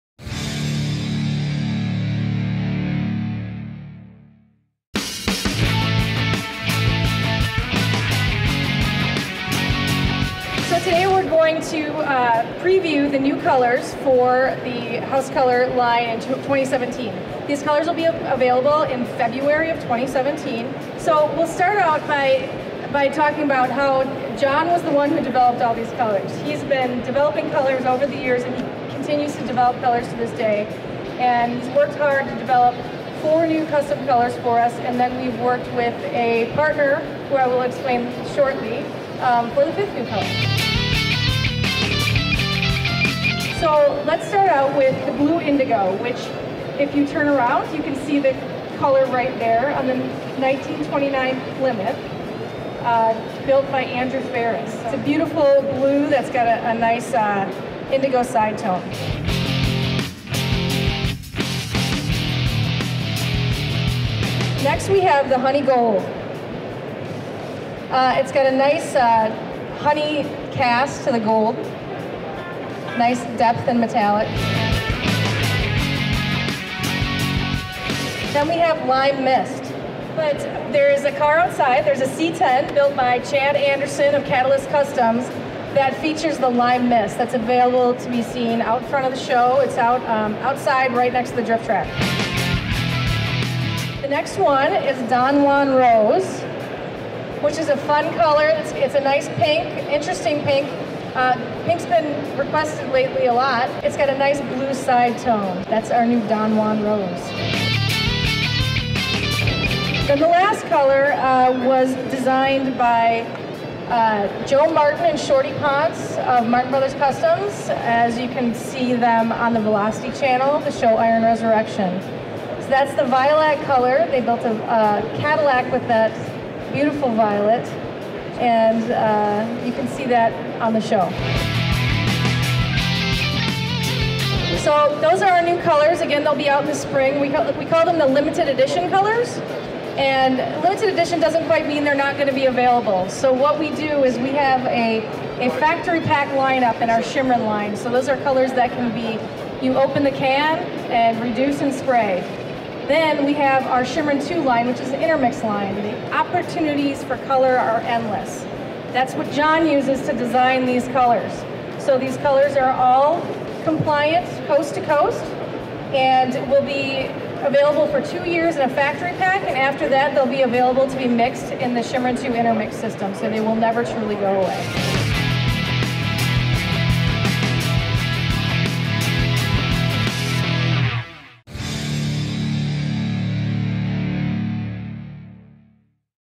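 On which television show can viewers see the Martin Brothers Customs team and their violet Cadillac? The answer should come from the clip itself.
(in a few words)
Iron Resurrection.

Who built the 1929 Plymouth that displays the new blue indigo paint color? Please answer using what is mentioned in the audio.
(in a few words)
Andrew Ferris.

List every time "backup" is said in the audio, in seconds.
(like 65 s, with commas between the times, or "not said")
not said.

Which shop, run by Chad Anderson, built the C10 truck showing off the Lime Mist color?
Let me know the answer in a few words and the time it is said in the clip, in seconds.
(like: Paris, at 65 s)
Catalyst Customs, at 84 s.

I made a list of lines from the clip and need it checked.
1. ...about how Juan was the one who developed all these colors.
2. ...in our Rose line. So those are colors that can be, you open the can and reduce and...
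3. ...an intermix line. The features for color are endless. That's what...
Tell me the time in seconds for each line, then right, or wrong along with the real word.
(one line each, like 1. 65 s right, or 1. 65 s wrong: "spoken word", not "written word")
1. 23 s wrong: "Jon", not "Juan"
2. 146 s wrong: "Shimrin", not "Rose"
3. 154 s wrong: "opportunities", not "features".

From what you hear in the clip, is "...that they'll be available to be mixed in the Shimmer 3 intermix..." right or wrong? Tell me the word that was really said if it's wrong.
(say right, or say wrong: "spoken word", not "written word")
wrong: "2", not "3".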